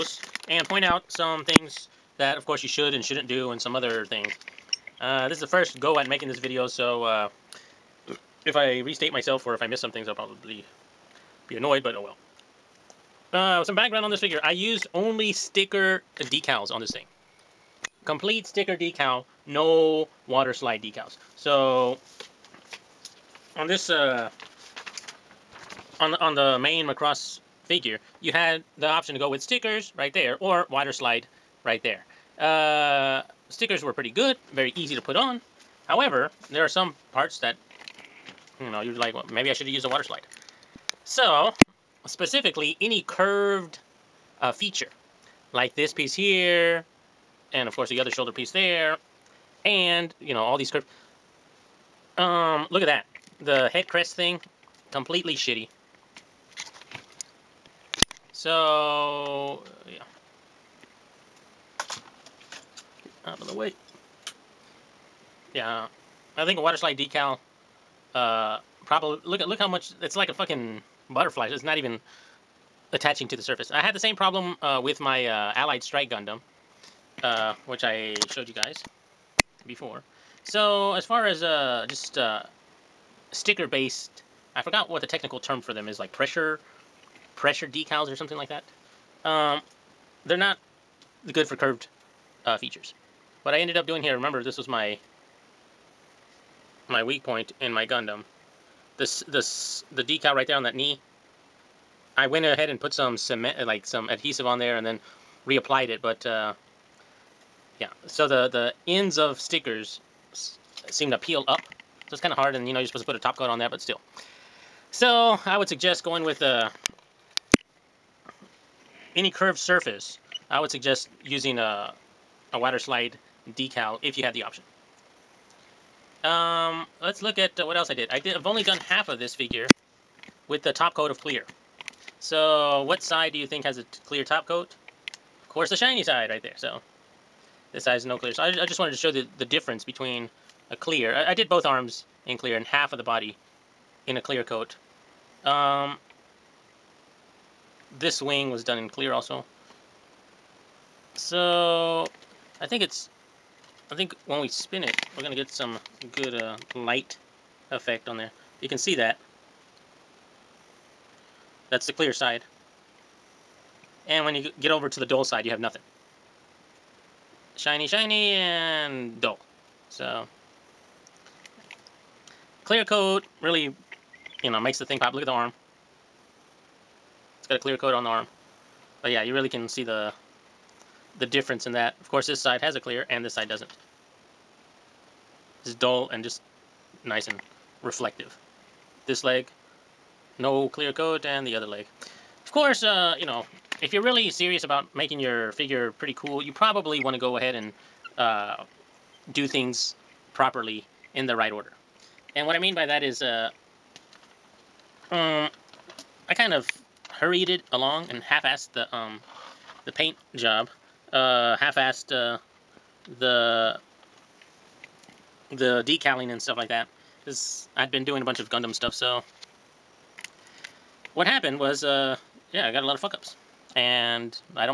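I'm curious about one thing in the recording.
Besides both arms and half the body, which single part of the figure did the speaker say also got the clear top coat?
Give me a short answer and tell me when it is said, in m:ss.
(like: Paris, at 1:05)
wing, at 2:28.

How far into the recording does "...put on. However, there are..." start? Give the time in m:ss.
0:34.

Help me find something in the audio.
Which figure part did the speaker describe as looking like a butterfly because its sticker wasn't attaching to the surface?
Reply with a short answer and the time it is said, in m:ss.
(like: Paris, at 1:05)
head crest, at 0:53.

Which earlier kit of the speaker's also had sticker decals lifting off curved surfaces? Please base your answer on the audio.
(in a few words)
Allied Strike Gundam.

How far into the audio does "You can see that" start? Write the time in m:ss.
2:38.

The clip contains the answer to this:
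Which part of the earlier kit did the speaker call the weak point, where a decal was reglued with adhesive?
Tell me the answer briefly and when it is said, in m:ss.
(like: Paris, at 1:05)
knee, at 1:40.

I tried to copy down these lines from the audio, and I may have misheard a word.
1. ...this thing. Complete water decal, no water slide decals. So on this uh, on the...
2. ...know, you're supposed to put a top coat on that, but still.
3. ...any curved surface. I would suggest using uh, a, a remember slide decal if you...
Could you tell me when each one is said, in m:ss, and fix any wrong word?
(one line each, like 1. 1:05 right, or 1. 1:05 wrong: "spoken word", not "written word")
1. 0:16 wrong: "sticker", not "water"
2. 1:52 right
3. 1:59 wrong: "water", not "remember".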